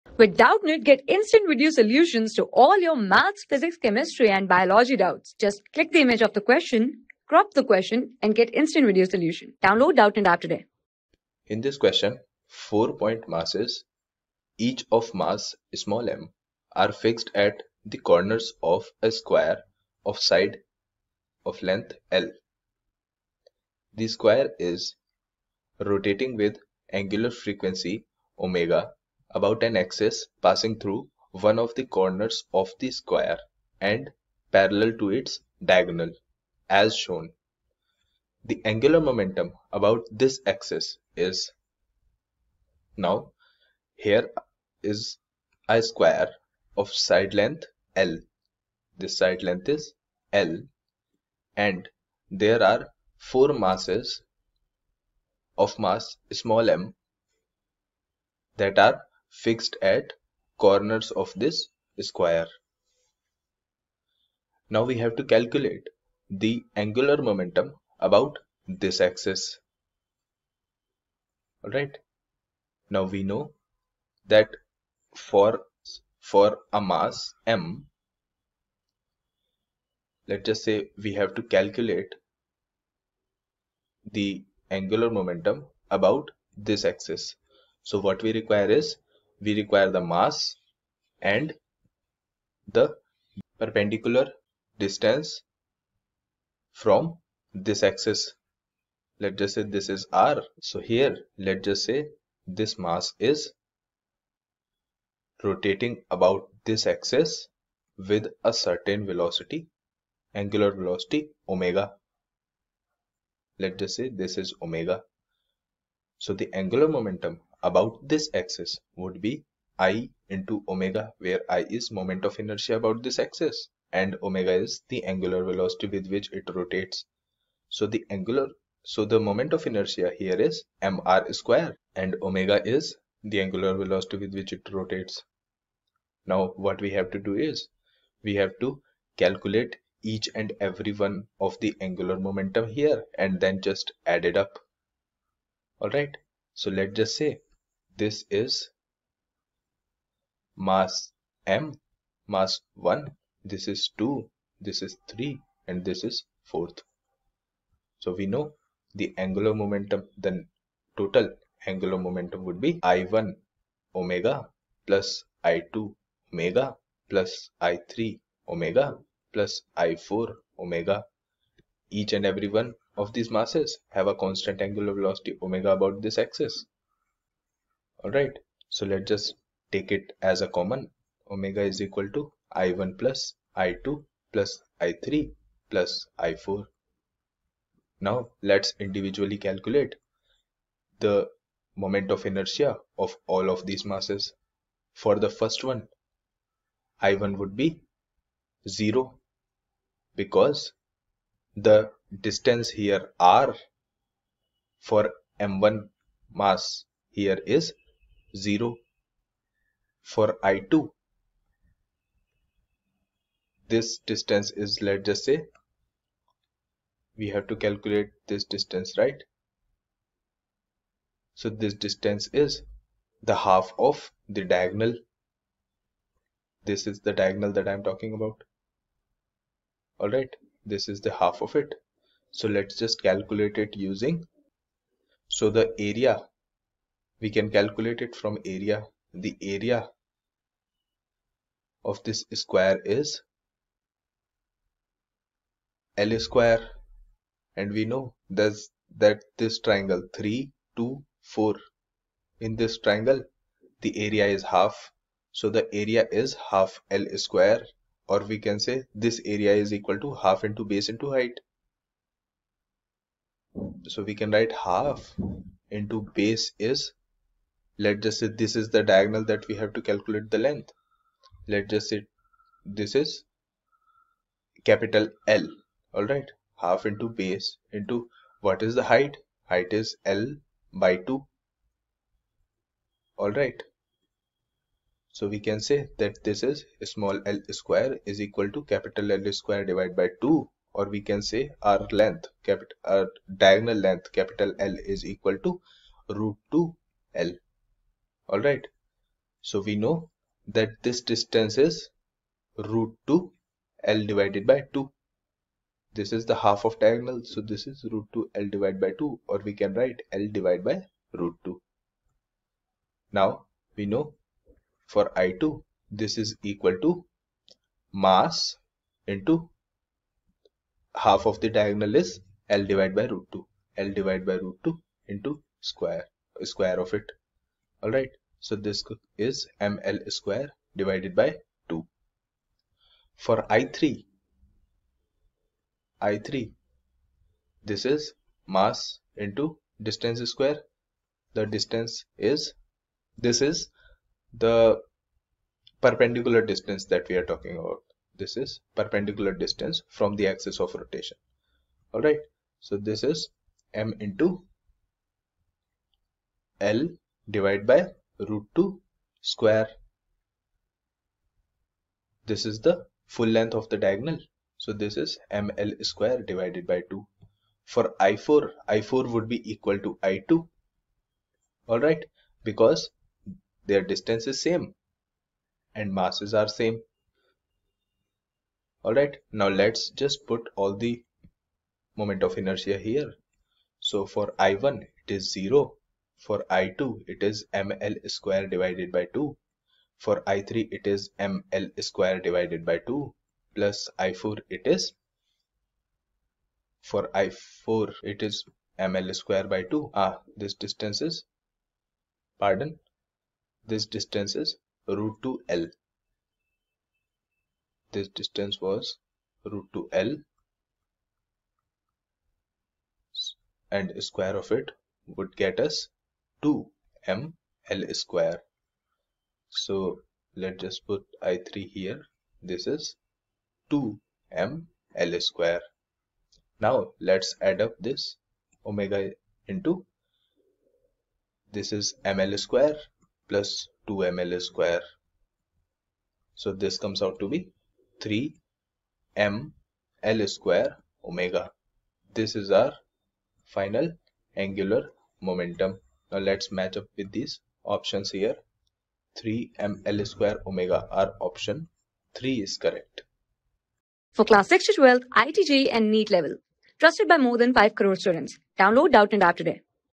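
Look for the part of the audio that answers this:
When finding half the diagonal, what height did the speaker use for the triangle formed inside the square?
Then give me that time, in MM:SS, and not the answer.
04:40.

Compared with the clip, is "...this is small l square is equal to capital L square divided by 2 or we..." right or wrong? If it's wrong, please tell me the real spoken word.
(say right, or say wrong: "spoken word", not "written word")
right.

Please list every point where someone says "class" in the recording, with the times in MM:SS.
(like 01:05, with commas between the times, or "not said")
07:34.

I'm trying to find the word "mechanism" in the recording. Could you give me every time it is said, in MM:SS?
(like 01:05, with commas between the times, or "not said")
not said.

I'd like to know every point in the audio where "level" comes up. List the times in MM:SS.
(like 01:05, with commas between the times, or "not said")
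07:36.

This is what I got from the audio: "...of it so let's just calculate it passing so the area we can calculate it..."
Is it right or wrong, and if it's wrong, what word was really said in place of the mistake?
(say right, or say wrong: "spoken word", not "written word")
wrong: "using", not "passing".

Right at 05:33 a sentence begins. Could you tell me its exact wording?
For I3, I3, this is mass into distance square.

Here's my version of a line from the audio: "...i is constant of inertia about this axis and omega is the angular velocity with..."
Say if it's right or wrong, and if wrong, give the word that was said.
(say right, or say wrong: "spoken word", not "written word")
wrong: "moment", not "constant".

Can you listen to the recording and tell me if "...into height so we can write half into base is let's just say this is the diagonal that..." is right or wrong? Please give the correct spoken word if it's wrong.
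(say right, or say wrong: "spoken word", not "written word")
right.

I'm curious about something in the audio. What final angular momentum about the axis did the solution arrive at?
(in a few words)
3mL²ω.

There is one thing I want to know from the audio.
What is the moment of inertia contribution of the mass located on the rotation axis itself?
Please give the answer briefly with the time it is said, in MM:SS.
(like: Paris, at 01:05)
0, at 03:17.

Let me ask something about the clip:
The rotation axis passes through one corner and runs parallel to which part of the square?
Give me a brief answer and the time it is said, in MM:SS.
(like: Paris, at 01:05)
its diagonal, at 00:35.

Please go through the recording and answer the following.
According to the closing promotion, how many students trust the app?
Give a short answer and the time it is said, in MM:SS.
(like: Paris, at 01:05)
more than 5 crore, at 07:37.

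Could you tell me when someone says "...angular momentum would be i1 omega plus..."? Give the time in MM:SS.
02:41.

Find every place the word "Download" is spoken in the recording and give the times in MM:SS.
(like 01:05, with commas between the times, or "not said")
00:09, 07:38.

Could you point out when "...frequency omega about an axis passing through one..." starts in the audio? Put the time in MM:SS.
00:27.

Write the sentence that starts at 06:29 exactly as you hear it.
For I3, it is ml square divided by 2 plus I4, it is for I4, it is ml square by 2.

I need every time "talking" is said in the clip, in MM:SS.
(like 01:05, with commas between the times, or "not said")
03:47, 05:47.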